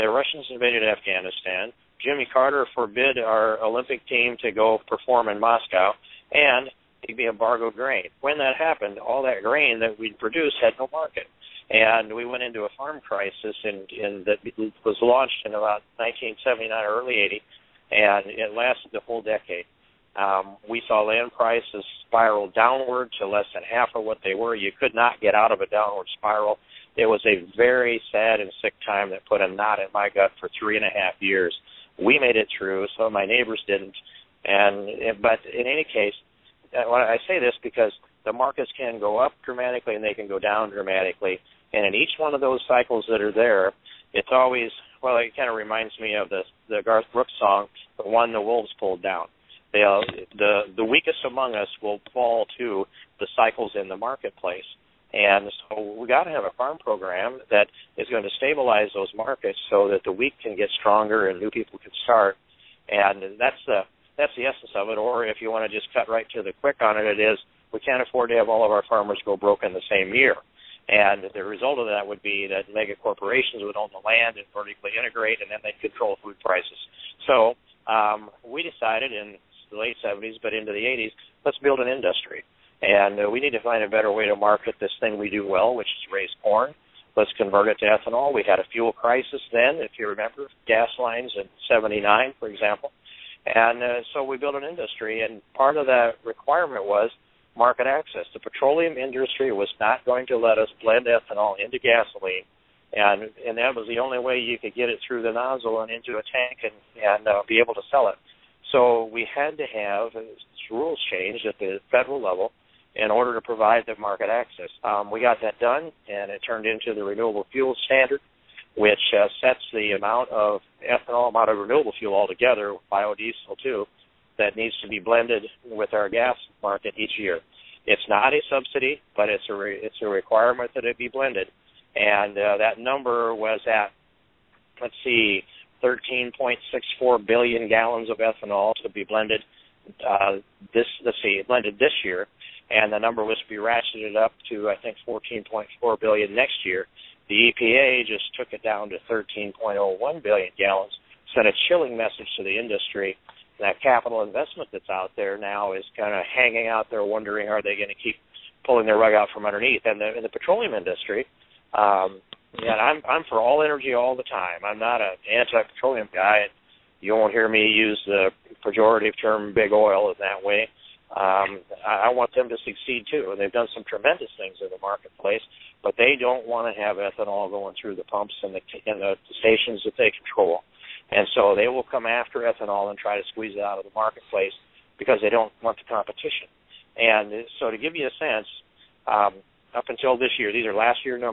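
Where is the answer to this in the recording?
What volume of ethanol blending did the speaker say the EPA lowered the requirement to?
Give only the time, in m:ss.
2:29.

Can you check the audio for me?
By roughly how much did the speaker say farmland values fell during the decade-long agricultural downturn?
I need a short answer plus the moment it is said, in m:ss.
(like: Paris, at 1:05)
less than half, at 0:23.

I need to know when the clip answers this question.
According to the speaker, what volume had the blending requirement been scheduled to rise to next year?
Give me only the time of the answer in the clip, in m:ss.
2:25.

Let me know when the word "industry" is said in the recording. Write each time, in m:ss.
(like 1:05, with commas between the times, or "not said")
1:21, 1:34, 1:38, 2:32, 2:40.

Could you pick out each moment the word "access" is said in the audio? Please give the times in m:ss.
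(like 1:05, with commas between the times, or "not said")
1:37, 1:54.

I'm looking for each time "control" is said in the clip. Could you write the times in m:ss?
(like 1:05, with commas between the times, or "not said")
1:15, 3:00.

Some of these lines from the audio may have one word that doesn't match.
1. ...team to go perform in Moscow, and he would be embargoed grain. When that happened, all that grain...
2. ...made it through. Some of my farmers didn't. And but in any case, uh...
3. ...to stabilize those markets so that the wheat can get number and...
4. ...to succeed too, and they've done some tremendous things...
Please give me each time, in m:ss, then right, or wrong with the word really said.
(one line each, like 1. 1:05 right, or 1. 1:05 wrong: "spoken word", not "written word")
1. 0:04 right
2. 0:32 wrong: "neighbors", not "farmers"
3. 0:58 wrong: "stronger", not "number"
4. 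2:52 right.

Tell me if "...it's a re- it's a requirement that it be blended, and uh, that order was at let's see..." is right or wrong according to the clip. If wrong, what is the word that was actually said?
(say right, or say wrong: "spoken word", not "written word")
wrong: "number", not "order".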